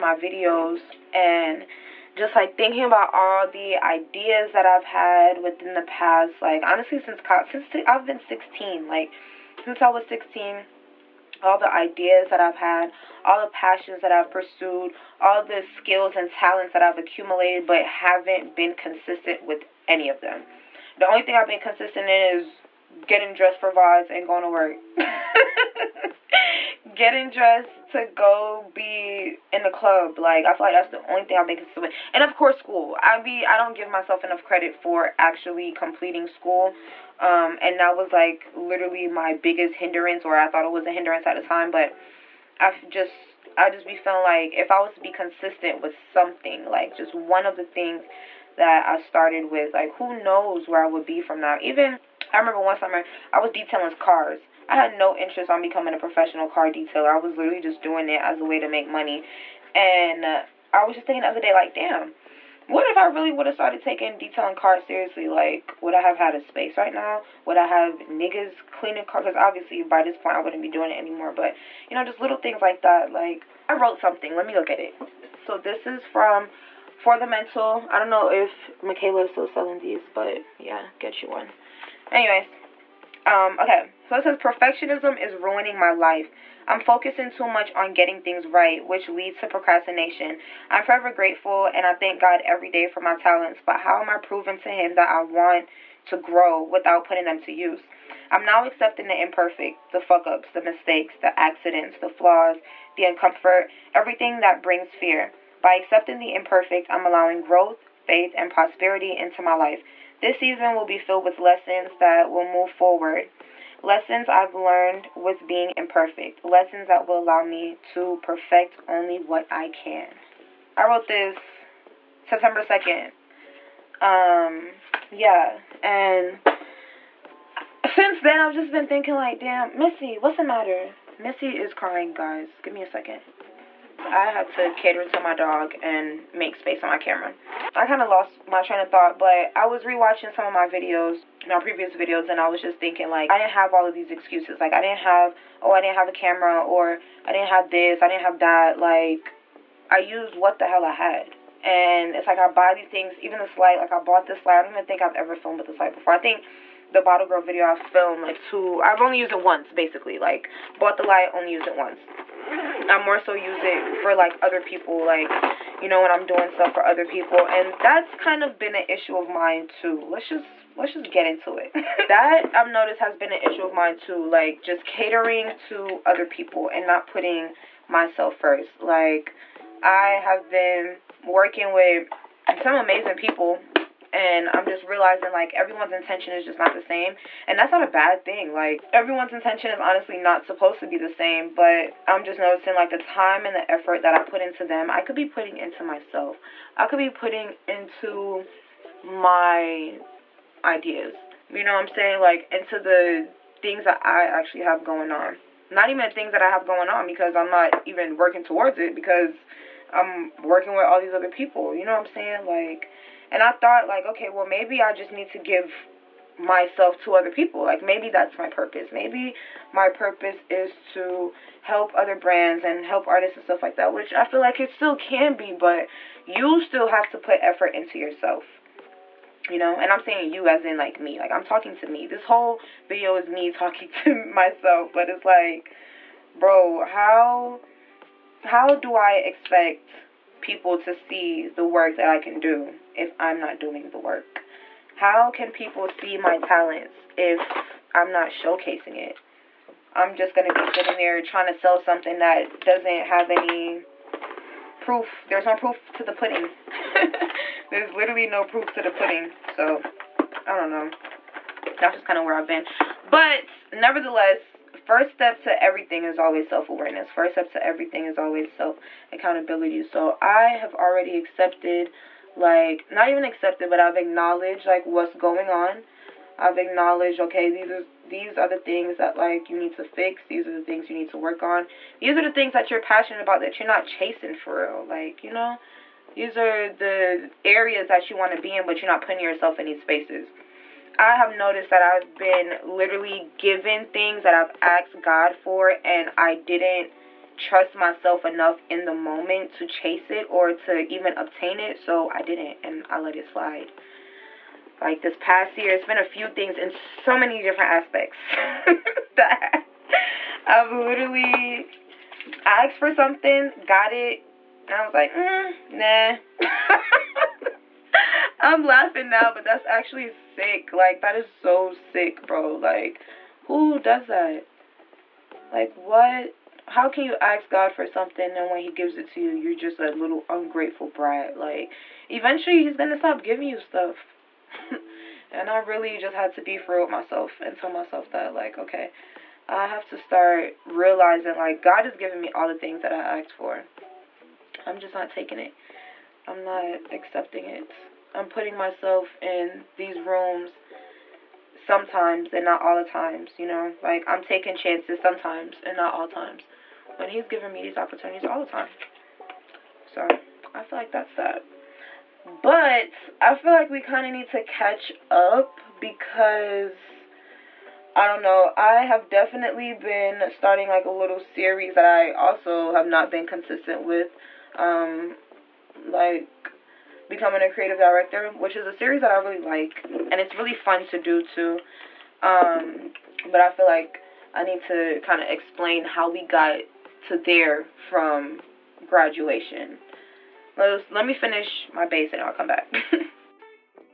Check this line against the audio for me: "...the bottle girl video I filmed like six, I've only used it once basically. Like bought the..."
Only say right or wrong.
wrong.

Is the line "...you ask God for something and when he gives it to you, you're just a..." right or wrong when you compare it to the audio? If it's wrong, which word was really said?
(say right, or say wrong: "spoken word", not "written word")
right.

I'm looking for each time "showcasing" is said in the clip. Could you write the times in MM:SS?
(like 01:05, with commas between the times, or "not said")
04:08.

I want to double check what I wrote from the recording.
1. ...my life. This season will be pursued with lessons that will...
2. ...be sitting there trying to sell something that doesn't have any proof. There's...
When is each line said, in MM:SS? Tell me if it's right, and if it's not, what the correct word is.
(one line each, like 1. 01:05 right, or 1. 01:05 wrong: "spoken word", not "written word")
1. 01:49 wrong: "filled", not "pursued"
2. 04:10 right.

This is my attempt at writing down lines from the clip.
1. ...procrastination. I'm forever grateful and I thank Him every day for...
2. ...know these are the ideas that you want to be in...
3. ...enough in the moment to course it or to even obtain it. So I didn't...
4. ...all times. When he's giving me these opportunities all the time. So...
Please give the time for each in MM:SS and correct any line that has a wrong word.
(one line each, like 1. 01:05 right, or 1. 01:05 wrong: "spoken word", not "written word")
1. 01:29 wrong: "God", not "Him"
2. 04:45 wrong: "areas", not "ideas"
3. 04:58 wrong: "chase", not "course"
4. 05:55 right.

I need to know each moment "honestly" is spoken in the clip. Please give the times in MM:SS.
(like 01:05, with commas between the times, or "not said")
00:06, 03:09.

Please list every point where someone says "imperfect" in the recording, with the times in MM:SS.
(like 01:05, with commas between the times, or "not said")
01:39, 01:46, 01:55.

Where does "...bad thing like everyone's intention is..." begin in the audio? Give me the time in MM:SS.
03:07.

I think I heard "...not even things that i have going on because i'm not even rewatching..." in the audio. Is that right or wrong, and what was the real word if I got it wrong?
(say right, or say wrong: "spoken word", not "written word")
wrong: "working", not "rewatching".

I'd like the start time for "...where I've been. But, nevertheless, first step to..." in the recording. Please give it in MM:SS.
04:22.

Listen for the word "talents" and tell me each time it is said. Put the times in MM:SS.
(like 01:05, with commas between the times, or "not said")
00:16, 01:33, 04:06.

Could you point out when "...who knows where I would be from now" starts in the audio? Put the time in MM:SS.
00:49.